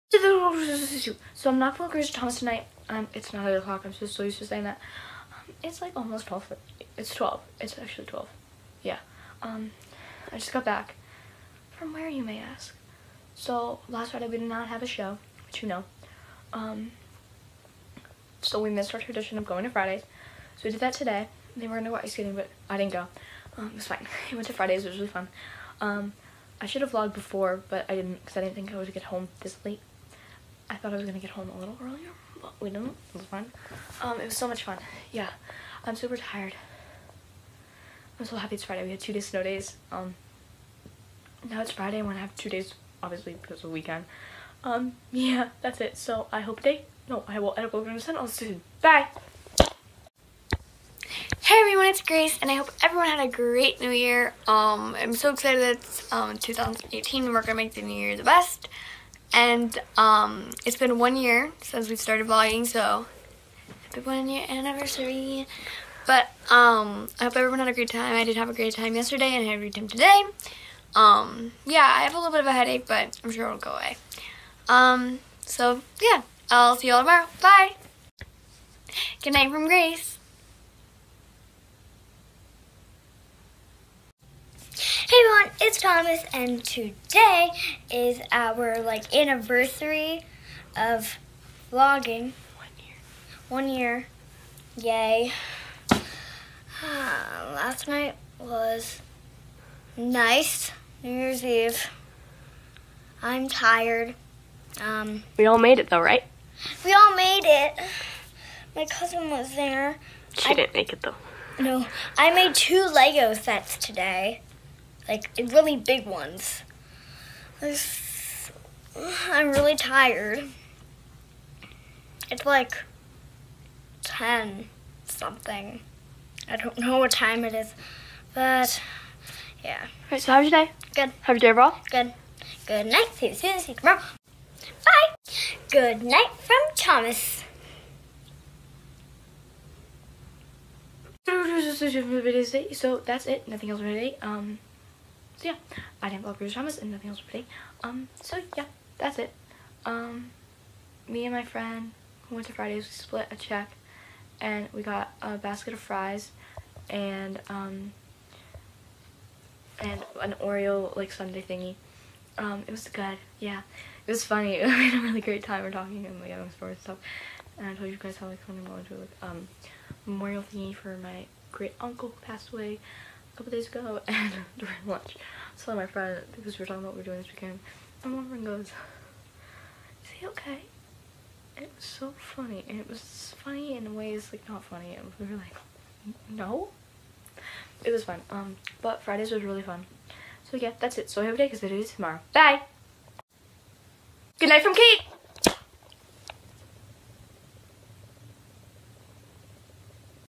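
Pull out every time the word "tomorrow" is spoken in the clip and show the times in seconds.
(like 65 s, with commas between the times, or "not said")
77 s, 133 s, 191 s.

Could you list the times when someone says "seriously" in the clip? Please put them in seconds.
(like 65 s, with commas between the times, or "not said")
not said.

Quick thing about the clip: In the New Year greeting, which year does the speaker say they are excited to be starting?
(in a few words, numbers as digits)
2018.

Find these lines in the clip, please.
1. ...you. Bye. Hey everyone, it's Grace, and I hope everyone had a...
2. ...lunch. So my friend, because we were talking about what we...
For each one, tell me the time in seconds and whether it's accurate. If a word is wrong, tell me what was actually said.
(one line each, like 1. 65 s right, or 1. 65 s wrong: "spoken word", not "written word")
1. 48 s right
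2. 174 s right.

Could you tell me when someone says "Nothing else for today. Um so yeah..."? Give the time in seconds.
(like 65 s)
143 s.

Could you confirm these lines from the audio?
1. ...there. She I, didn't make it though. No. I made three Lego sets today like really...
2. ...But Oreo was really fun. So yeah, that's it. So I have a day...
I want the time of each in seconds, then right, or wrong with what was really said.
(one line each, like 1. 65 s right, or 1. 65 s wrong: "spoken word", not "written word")
1. 109 s wrong: "two", not "three"
2. 188 s wrong: "Fridays", not "Oreo".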